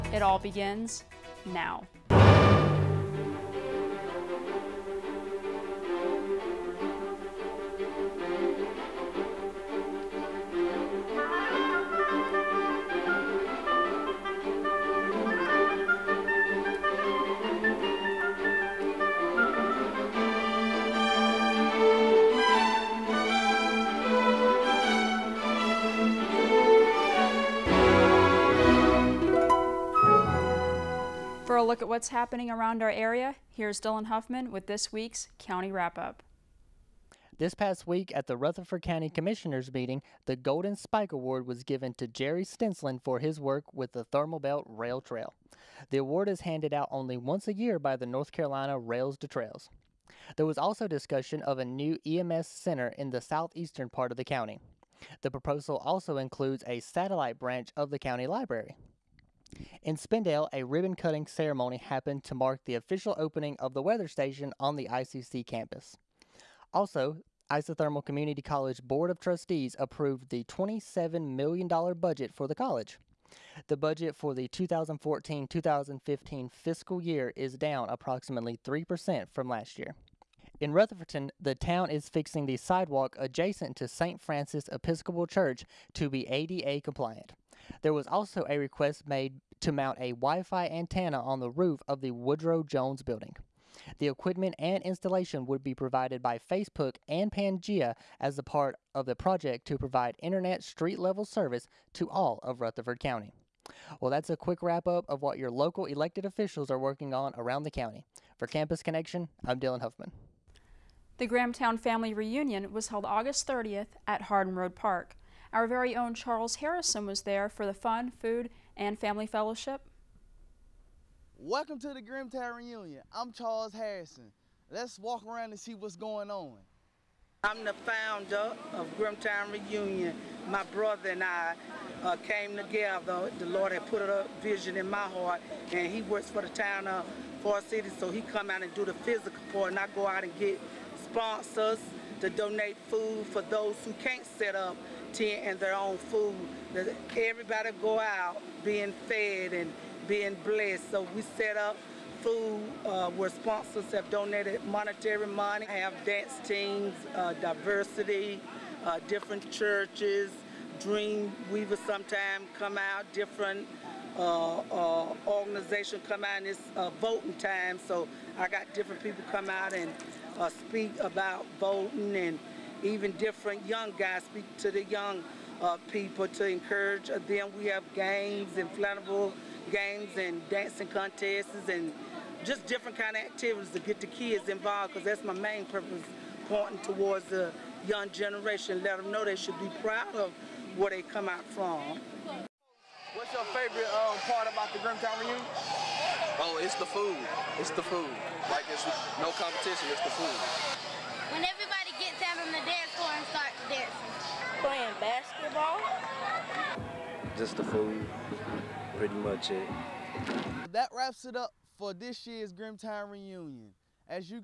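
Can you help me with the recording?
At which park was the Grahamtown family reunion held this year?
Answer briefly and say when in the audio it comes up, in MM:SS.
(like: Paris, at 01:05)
Hardin Road Park, at 01:54.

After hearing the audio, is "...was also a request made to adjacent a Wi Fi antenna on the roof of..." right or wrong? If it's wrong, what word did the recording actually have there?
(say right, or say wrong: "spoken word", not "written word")
wrong: "mount", not "adjacent".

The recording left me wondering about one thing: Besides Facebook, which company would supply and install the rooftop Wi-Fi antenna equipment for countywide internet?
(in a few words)
Pangea.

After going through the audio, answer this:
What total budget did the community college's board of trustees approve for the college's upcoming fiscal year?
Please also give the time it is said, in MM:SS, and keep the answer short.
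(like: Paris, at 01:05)
$27 million, at 01:10.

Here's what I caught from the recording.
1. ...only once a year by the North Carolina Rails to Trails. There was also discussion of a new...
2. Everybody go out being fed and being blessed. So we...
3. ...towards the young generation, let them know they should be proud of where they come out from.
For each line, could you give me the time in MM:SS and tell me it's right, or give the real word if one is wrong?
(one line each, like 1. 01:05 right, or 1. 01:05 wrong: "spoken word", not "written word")
1. 00:46 right
2. 02:27 right
3. 03:06 right.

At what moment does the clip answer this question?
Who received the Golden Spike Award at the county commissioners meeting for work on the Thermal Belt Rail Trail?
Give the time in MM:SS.
00:42.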